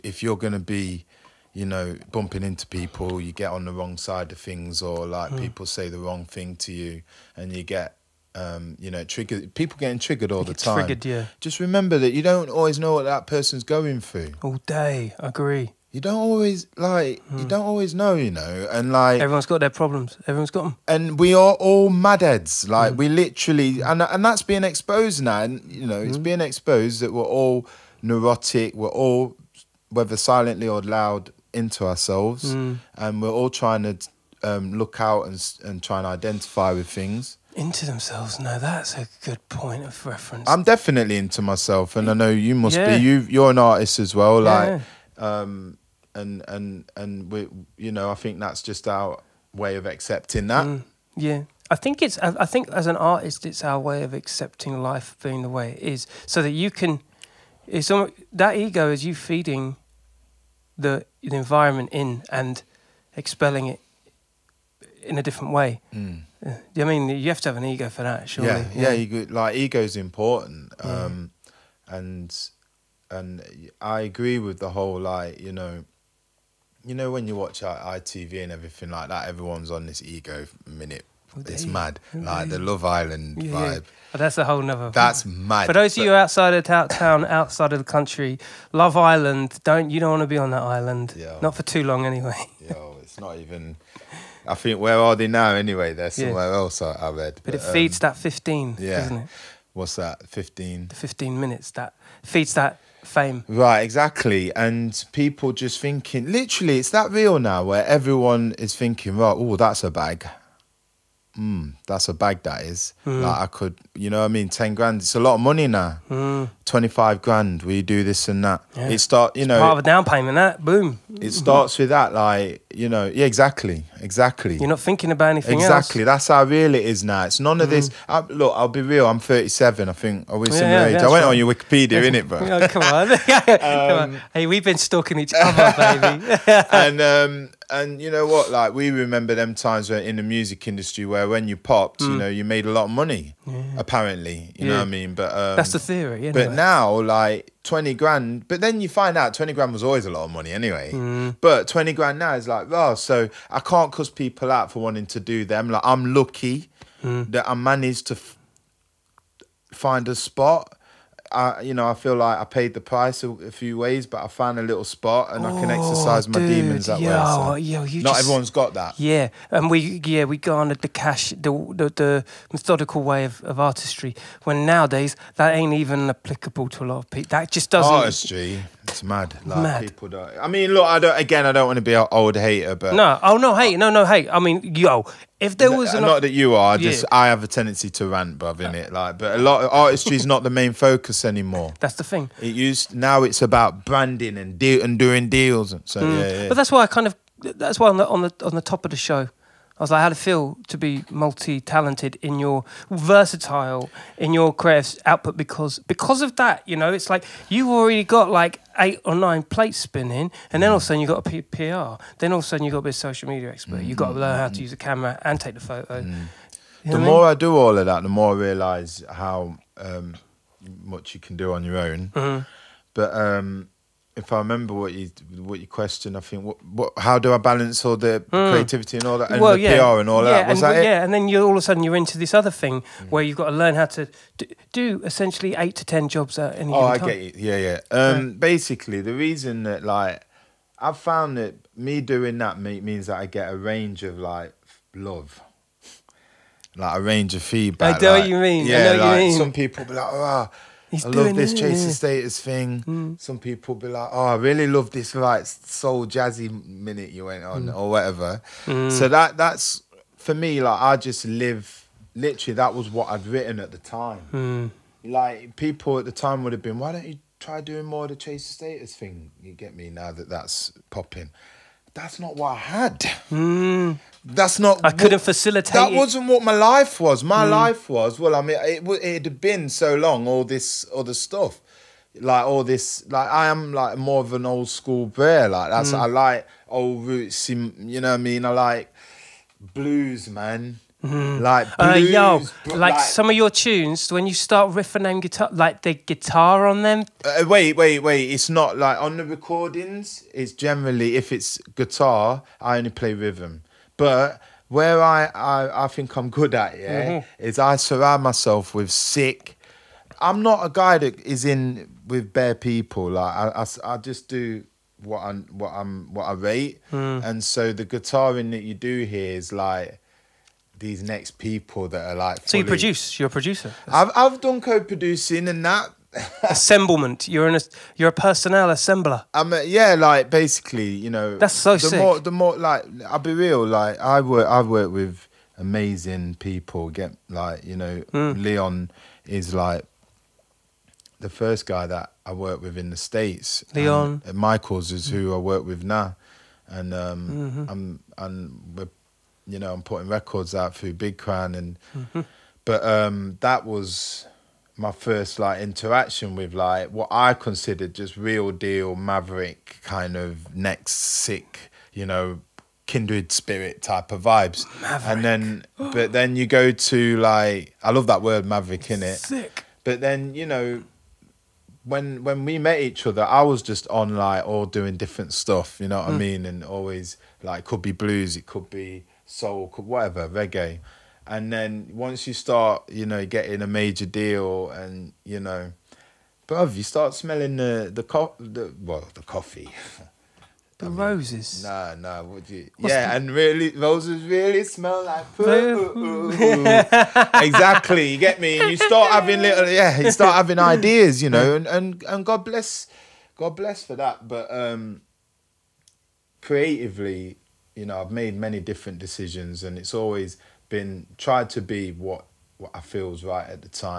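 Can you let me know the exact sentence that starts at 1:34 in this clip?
I think where are they now?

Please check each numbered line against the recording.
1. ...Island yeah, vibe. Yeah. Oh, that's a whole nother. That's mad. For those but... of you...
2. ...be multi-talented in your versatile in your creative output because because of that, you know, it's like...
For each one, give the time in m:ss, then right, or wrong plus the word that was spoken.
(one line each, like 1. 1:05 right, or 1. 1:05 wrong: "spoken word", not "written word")
1. 1:22 right
2. 3:20 right.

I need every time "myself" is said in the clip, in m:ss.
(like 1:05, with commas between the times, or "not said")
0:41, 5:08.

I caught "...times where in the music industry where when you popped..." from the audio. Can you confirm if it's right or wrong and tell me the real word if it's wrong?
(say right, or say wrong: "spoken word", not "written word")
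right.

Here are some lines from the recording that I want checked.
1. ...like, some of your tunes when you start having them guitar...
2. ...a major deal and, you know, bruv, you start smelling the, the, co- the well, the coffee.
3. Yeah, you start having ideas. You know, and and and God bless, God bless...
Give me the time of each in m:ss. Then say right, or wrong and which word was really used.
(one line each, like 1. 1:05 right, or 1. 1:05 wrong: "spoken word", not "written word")
1. 4:52 wrong: "riffing", not "having"
2. 6:23 right
3. 6:39 right.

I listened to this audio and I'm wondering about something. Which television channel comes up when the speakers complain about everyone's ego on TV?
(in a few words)
ITV.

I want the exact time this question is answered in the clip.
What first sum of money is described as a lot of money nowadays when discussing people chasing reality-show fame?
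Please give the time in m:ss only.
1:54.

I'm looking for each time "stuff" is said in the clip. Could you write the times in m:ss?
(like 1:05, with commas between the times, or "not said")
4:41, 6:15.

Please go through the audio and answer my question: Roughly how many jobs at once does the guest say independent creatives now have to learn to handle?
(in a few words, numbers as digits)
8 to 10.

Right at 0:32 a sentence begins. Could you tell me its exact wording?
and we're all trying to um, look out and and try and identify with things into themselves.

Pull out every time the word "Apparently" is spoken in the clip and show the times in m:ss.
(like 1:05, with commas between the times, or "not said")
2:23.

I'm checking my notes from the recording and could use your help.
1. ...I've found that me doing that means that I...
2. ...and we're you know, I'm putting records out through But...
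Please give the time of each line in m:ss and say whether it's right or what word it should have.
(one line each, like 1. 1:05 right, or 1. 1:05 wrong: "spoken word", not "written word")
1. 4:00 right
2. 5:48 wrong: "Big", not "But".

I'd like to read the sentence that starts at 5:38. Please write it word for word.
Leon is like the first guy that I worked with in the states.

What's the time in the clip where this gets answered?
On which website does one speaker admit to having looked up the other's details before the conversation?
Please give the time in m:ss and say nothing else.
2:11.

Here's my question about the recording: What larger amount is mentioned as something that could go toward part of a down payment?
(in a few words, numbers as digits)
25 grand.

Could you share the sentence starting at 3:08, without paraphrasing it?
Like, but a lot of artistry is not the main focus anymore.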